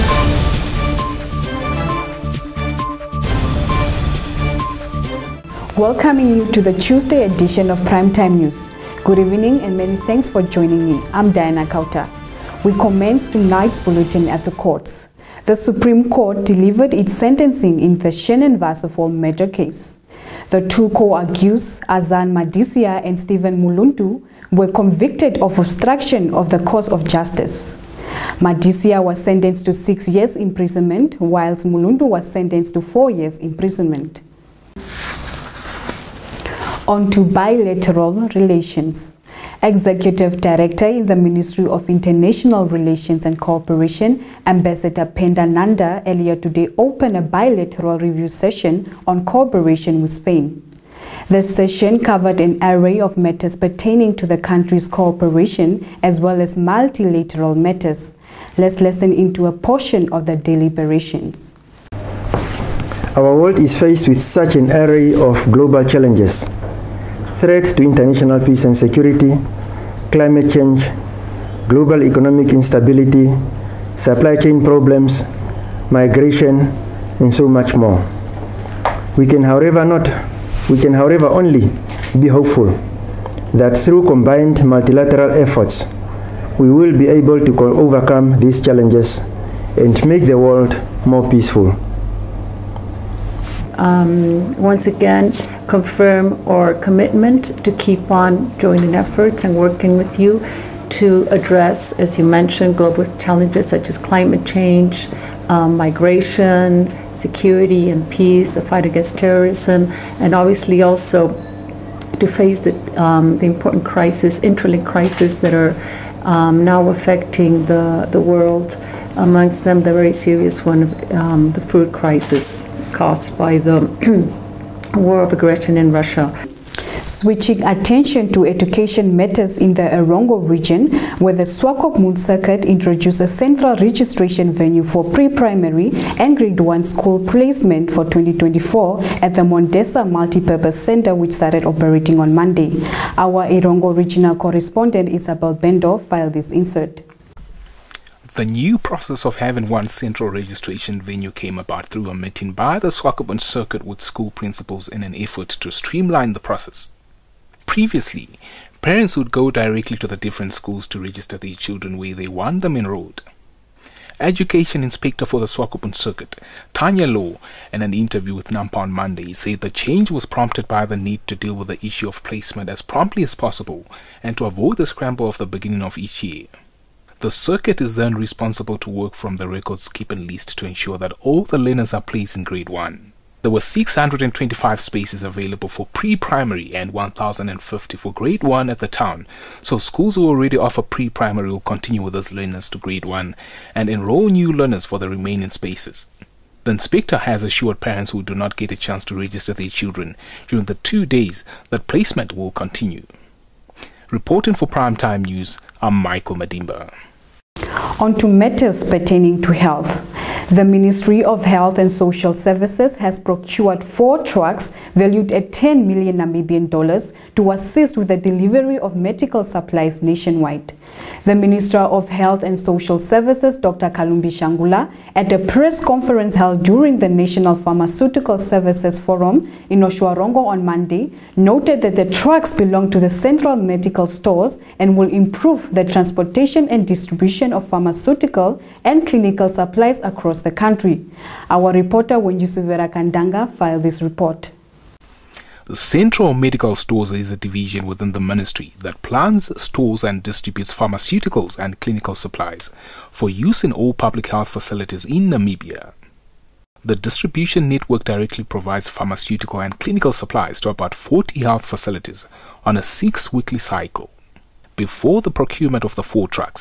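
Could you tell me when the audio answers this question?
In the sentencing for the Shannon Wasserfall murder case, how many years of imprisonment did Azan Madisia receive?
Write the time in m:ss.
0:29.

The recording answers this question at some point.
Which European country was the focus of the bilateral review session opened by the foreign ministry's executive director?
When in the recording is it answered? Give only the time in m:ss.
0:50.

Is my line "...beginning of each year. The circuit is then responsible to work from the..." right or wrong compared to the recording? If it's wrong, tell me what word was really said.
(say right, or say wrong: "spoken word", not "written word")
right.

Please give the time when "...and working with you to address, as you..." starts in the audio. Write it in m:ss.
1:39.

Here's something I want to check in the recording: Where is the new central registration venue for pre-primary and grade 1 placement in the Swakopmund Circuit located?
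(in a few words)
Mondesa Multipurpose Center.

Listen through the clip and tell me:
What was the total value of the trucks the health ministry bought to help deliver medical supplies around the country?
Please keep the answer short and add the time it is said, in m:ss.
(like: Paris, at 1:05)
10 million Namibian dollars, at 3:35.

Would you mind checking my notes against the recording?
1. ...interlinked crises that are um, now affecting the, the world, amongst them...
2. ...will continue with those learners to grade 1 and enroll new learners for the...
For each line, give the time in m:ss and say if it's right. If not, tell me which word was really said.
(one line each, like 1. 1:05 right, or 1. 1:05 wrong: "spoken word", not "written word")
1. 1:54 right
2. 3:11 right.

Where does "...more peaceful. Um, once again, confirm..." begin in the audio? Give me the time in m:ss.
1:31.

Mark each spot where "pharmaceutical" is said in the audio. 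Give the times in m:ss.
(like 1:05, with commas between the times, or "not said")
3:47, 3:57, 4:10, 4:18.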